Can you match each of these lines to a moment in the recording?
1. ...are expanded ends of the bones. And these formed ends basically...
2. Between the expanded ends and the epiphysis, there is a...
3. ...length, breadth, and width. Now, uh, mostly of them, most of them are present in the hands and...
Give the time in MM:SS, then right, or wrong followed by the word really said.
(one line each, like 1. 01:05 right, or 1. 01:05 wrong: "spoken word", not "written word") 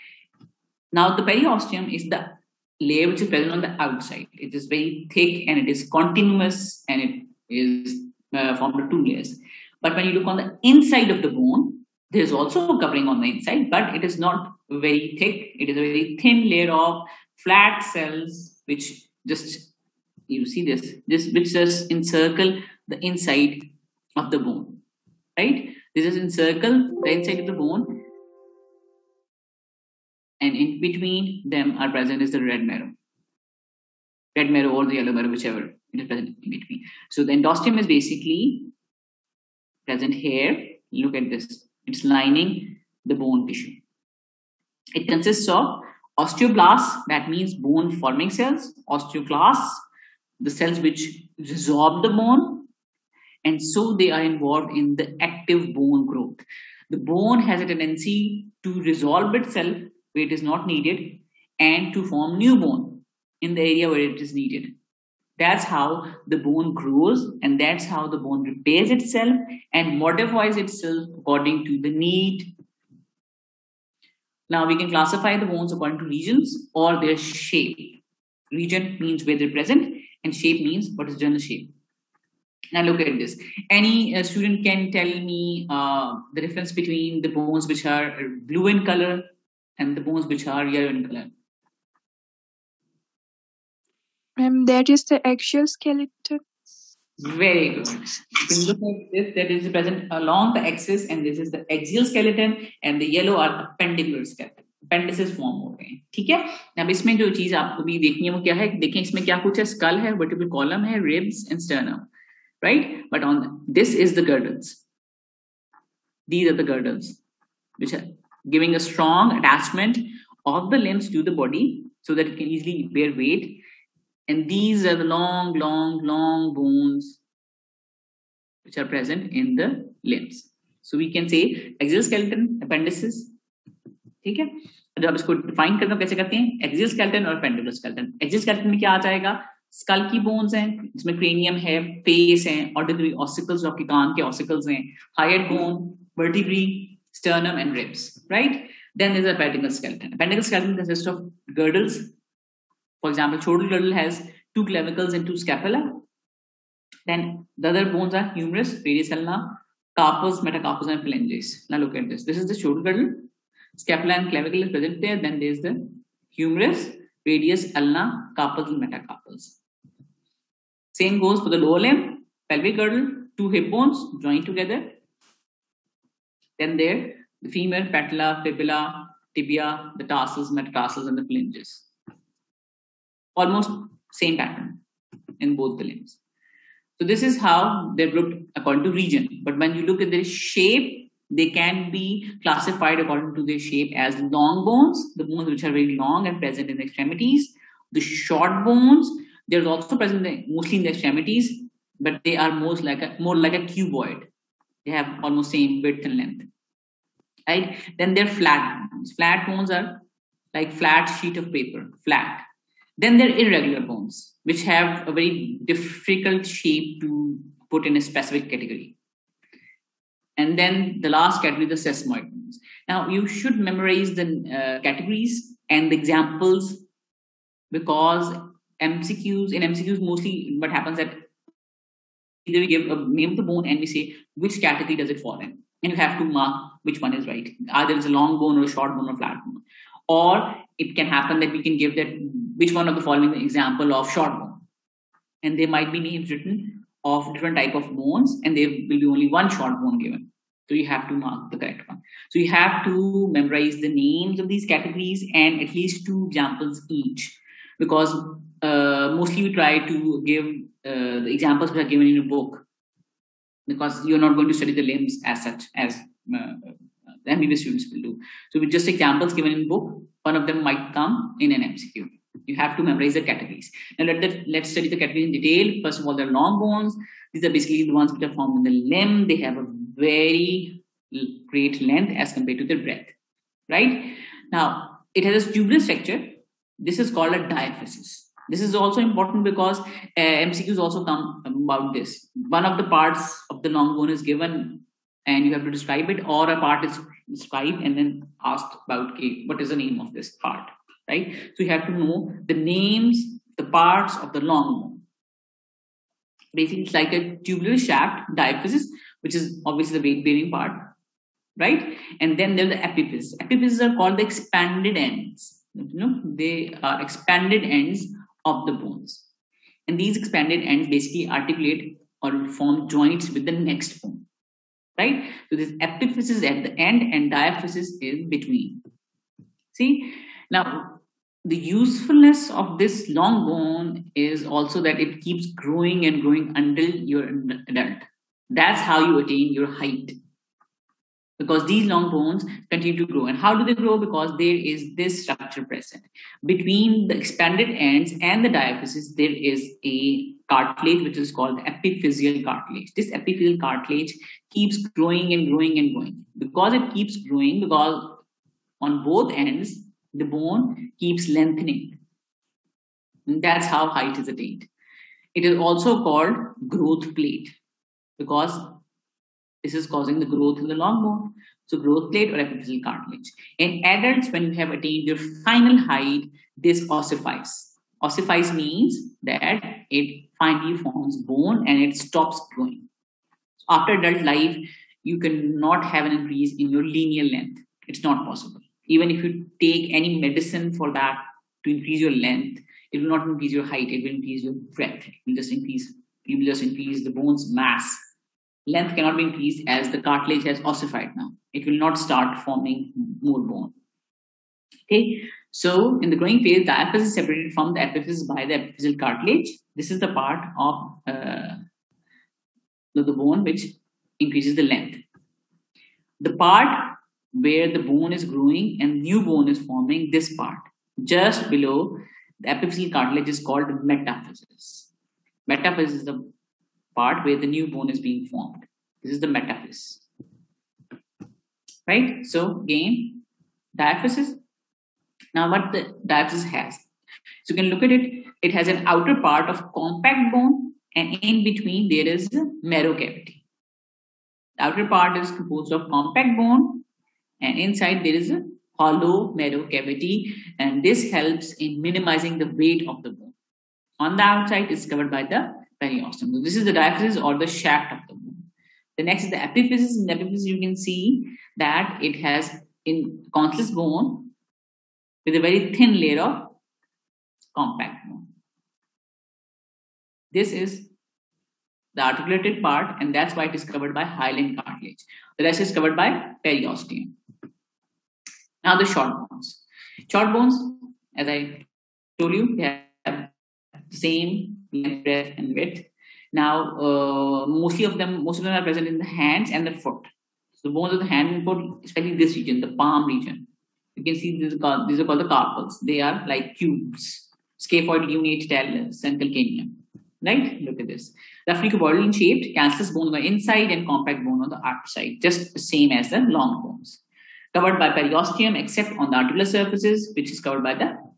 1. 05:16 wrong: "expanded", not "formed"
2. 05:46 wrong: "diaphysis", not "epiphysis"
3. 08:04 right.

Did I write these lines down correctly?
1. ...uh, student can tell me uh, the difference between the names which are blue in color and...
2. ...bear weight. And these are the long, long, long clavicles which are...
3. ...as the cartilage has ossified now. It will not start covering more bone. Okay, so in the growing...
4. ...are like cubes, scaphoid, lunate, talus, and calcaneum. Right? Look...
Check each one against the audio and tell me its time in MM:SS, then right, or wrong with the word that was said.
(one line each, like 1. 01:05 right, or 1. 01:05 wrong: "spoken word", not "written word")
1. 01:24 wrong: "bones", not "names"
2. 02:02 wrong: "bones", not "clavicles"
3. 06:39 wrong: "forming", not "covering"
4. 08:15 right.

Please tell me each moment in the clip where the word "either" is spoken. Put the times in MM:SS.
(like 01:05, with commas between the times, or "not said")
03:52, 03:57.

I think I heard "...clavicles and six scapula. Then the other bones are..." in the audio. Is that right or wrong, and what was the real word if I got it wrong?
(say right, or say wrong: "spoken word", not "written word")
wrong: "two", not "six".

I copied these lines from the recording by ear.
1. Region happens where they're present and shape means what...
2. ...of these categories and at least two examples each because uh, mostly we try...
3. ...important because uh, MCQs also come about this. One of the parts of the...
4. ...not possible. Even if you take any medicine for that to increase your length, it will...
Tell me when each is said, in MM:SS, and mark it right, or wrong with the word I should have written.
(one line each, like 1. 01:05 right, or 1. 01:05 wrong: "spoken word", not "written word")
1. 01:18 wrong: "means", not "happens"
2. 04:14 right
3. 04:48 right
4. 06:28 right.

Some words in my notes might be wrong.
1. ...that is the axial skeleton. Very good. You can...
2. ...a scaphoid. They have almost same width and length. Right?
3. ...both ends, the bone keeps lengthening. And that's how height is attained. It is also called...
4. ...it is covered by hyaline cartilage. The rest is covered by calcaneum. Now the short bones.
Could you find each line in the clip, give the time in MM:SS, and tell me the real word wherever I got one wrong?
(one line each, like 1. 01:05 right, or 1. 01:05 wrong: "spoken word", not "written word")
1. 01:34 right
2. 03:23 wrong: "cuboid", not "scaphoid"
3. 05:59 right
4. 07:53 wrong: "periosteum", not "calcaneum".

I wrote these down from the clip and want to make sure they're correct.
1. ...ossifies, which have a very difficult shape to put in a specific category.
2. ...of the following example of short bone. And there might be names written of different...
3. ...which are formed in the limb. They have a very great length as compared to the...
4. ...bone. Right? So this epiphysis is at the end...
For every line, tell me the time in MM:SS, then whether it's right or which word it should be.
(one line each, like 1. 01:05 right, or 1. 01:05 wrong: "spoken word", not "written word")
1. 03:33 wrong: "bones", not "ossifies"
2. 04:02 right
3. 04:38 right
4. 05:24 right.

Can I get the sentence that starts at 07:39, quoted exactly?
In the epiphysis, you can see that it has in conscious bone with a very thin layer of compact bone.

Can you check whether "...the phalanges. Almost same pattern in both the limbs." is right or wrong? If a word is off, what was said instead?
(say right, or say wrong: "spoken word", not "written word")
right.